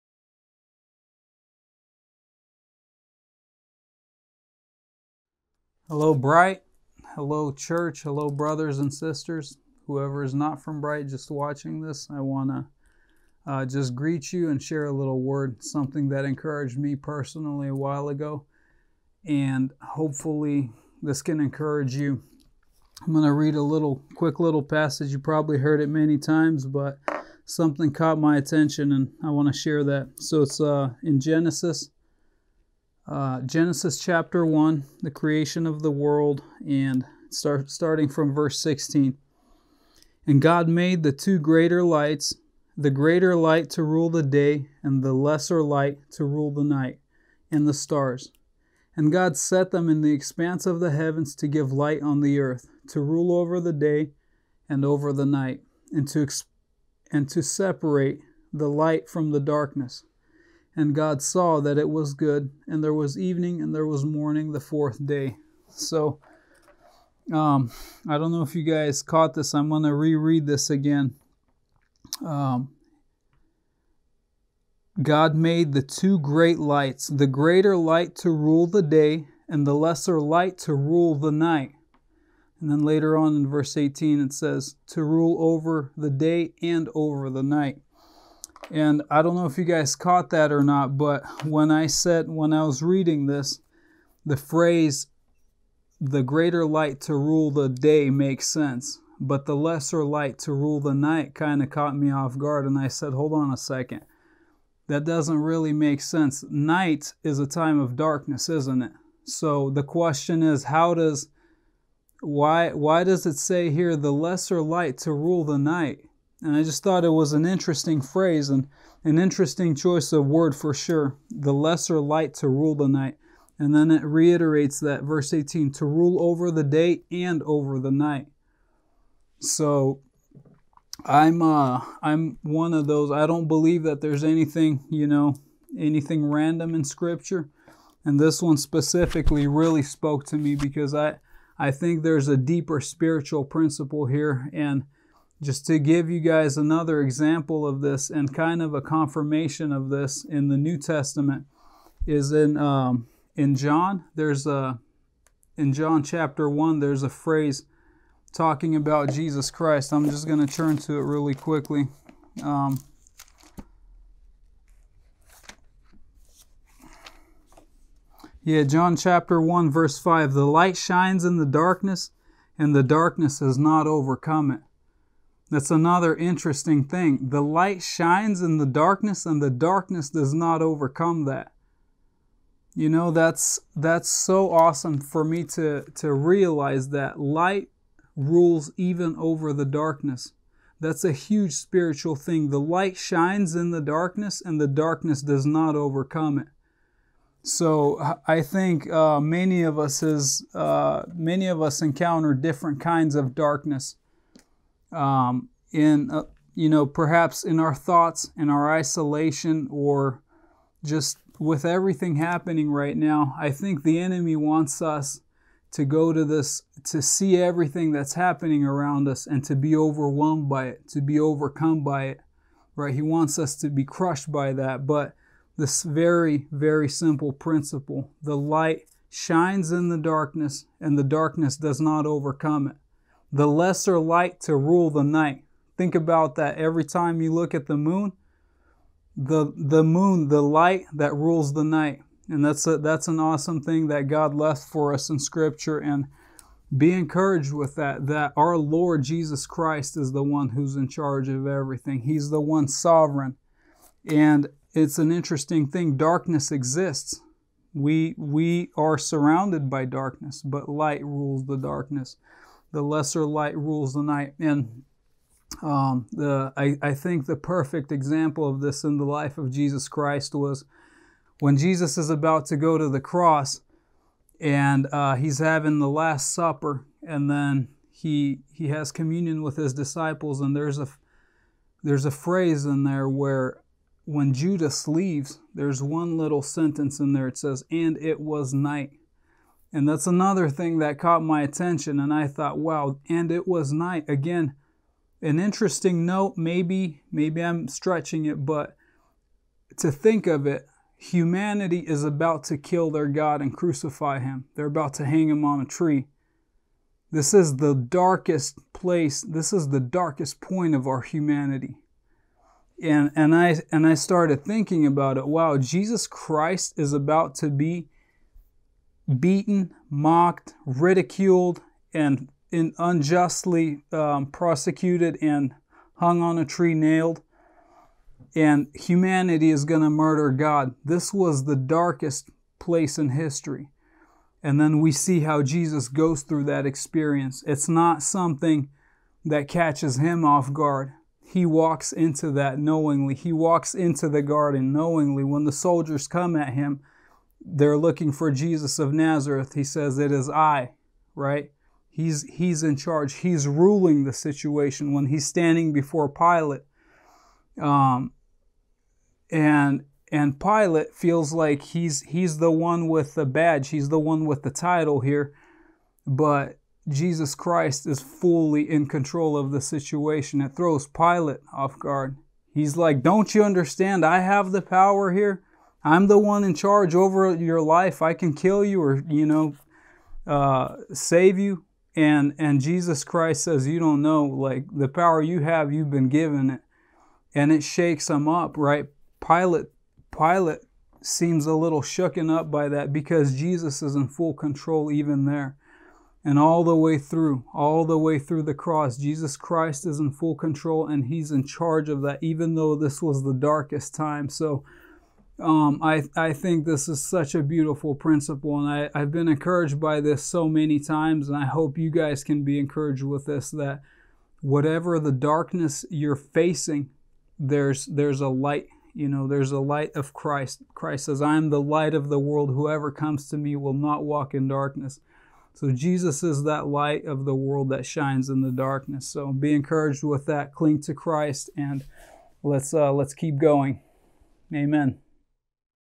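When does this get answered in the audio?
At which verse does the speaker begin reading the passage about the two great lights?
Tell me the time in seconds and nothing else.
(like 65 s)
38 s.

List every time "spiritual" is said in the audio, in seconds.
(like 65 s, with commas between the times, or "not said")
142 s, 191 s.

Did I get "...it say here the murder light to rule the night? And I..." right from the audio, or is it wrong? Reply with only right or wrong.
wrong.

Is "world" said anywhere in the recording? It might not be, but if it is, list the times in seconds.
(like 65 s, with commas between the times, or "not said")
35 s, 422 s, 427 s.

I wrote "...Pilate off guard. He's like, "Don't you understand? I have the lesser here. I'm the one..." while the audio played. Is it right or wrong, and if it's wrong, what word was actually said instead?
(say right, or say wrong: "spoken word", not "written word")
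wrong: "power", not "lesser".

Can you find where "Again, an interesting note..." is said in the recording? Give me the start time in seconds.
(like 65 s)
294 s.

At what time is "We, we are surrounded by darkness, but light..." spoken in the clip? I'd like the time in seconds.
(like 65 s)
257 s.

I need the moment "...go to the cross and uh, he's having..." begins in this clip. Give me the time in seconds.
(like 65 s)
272 s.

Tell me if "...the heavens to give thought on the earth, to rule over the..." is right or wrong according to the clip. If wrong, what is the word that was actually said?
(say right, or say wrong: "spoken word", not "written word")
wrong: "light", not "thought".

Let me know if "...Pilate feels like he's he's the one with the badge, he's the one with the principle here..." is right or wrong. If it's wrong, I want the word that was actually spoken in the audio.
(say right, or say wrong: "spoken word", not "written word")
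wrong: "title", not "principle".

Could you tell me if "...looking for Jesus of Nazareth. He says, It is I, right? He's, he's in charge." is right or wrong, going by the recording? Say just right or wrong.
right.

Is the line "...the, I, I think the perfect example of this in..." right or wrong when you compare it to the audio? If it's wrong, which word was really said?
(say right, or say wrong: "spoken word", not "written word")
right.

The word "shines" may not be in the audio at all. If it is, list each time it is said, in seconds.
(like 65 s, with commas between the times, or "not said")
170 s, 177 s, 192 s, 229 s, 427 s.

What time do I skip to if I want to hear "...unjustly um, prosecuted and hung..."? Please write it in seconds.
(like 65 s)
322 s.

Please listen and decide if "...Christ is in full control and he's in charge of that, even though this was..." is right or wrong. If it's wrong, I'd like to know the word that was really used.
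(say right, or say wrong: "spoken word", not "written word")
right.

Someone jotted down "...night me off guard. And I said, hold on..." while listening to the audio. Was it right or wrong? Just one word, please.
wrong.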